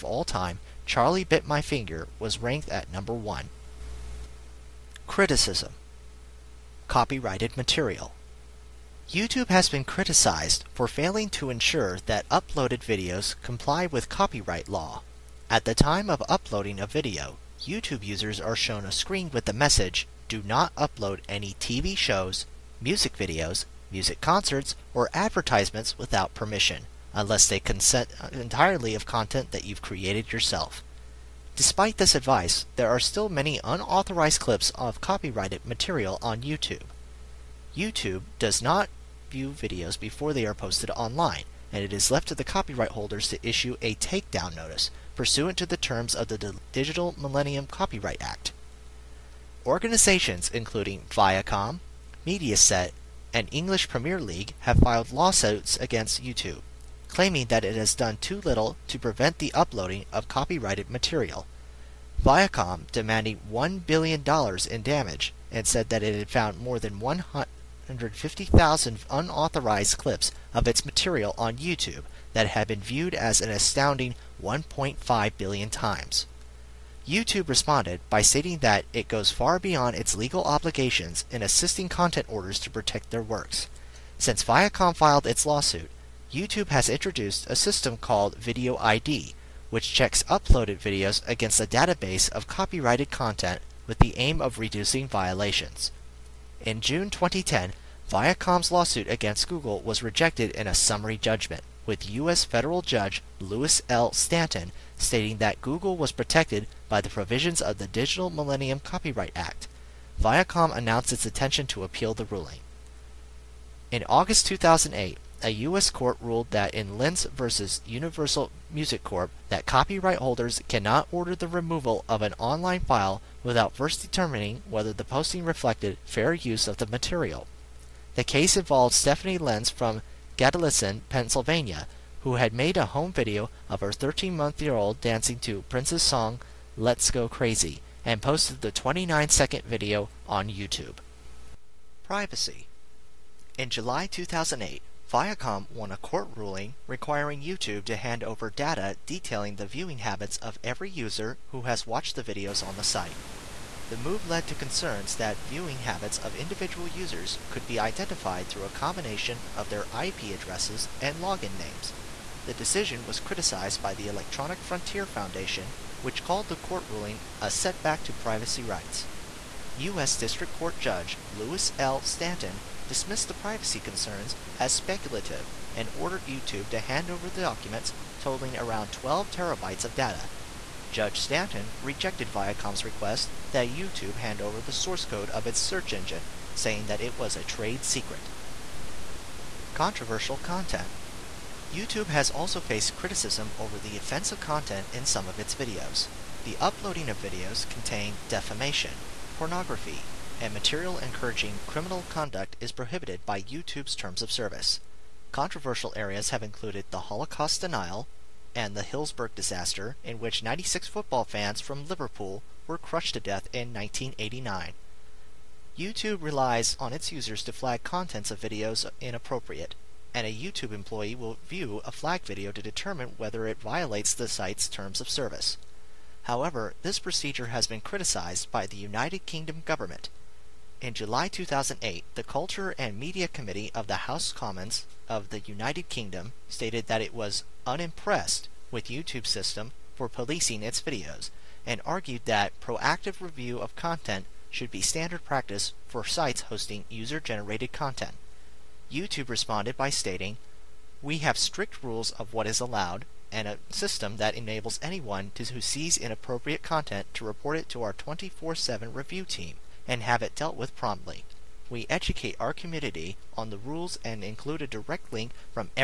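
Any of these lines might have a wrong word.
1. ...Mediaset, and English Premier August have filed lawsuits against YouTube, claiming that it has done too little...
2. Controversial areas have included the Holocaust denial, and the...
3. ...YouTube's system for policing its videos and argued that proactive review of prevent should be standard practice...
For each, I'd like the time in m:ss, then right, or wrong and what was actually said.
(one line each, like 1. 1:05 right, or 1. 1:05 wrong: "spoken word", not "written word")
1. 0:52 wrong: "League", not "August"
2. 3:25 right
3. 3:58 wrong: "content", not "prevent".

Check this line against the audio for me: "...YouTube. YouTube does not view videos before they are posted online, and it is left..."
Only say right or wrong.
right.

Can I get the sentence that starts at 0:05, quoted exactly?
Criticism Copyrighted material YouTube has been criticized for failing to ensure that uploaded videos comply with copyright law.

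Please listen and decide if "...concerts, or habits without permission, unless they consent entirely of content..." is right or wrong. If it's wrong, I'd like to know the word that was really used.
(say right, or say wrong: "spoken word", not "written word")
wrong: "advertisements", not "habits".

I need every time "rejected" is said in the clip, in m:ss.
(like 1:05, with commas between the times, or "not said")
1:40, 3:01.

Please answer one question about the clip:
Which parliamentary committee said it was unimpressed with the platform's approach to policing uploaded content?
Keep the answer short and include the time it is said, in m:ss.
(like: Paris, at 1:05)
Culture and Media Committee, at 3:52.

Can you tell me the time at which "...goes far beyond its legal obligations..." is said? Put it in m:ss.
1:19.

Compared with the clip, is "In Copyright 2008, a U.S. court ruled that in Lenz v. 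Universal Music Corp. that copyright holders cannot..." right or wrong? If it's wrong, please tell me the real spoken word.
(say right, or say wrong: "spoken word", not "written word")
wrong: "August", not "Copyright".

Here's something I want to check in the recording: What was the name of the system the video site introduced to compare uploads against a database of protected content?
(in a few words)
Video ID.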